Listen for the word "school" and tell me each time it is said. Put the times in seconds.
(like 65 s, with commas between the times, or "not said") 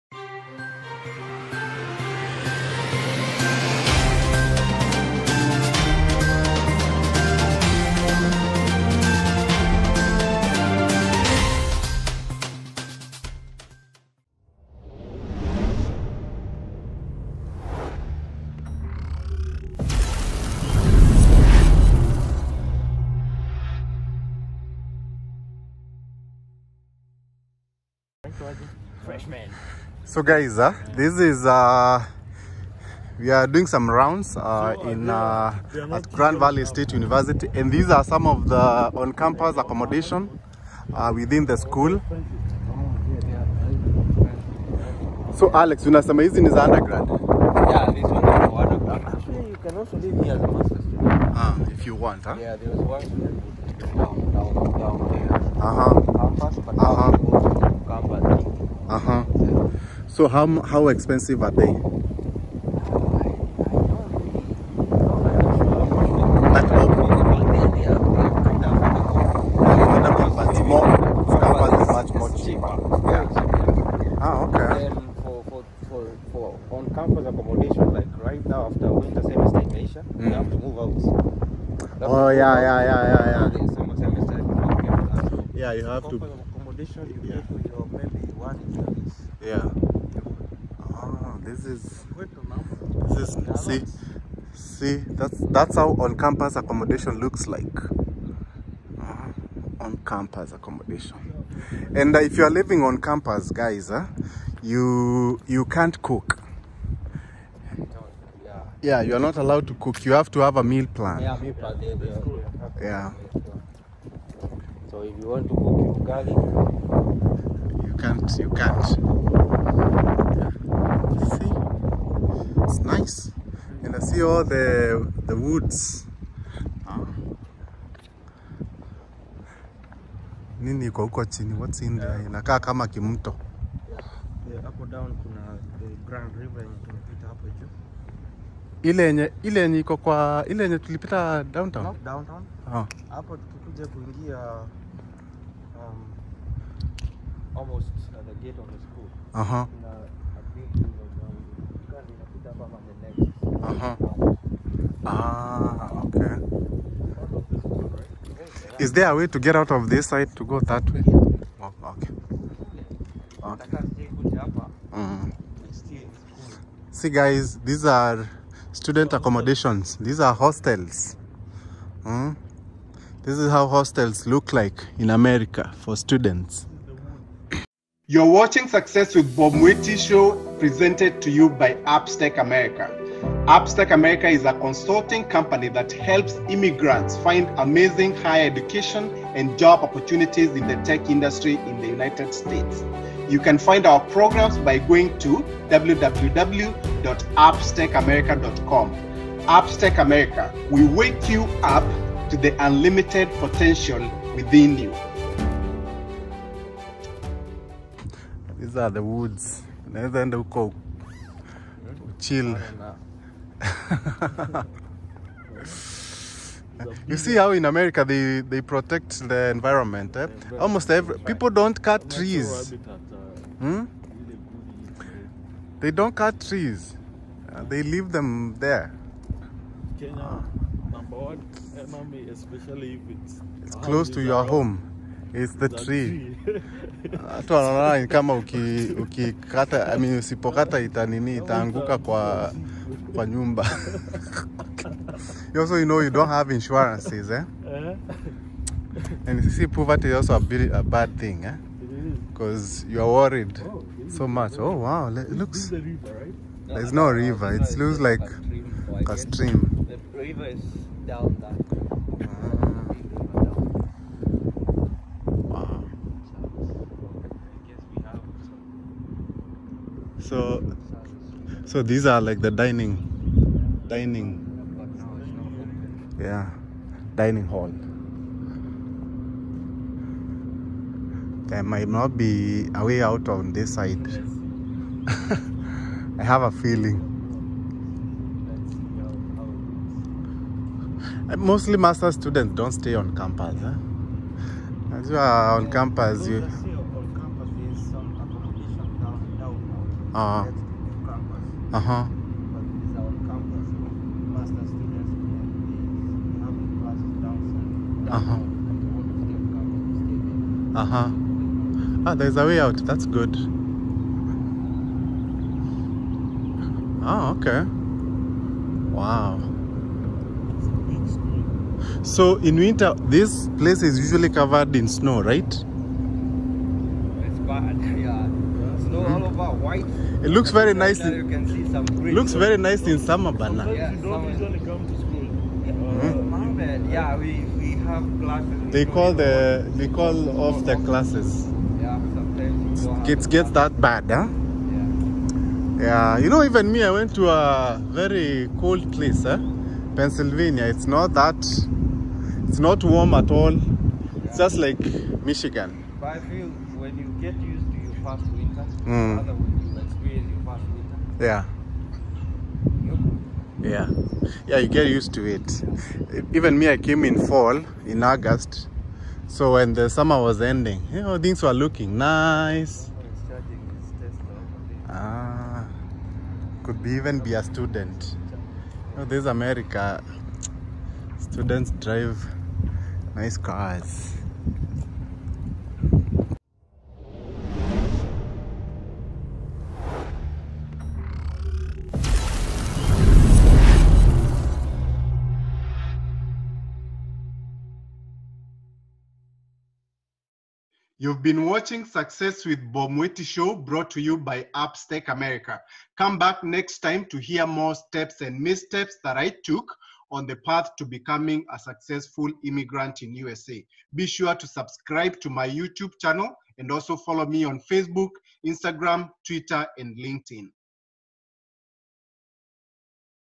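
41 s, 148 s, 334 s.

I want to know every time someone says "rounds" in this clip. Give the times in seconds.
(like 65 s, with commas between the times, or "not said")
33 s.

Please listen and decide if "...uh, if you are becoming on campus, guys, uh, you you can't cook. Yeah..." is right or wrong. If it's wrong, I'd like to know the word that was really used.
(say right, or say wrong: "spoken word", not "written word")
wrong: "living", not "becoming".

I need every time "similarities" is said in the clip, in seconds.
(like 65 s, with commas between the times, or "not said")
not said.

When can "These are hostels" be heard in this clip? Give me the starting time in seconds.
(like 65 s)
169 s.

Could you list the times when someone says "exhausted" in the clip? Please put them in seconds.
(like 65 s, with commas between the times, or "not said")
not said.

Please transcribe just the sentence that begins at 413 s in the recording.
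Be sure to subscribe to my YouTube channel and also follow me on Facebook, Instagram, Twitter, and LinkedIn.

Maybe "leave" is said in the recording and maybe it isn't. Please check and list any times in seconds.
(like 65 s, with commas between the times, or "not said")
227 s.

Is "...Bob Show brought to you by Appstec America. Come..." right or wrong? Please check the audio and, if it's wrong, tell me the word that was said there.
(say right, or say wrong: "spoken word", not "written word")
right.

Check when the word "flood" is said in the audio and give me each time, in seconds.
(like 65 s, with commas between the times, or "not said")
not said.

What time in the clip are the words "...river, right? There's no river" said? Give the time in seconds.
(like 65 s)
255 s.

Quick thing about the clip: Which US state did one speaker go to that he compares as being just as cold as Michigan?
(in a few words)
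Pennsylvania.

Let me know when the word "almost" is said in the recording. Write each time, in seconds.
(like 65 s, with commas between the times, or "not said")
147 s, 220 s.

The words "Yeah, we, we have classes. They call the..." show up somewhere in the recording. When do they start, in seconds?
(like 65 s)
336 s.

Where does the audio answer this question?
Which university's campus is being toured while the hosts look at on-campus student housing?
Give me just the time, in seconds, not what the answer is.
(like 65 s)
36 s.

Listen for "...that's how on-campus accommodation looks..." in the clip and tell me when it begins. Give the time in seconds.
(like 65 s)
95 s.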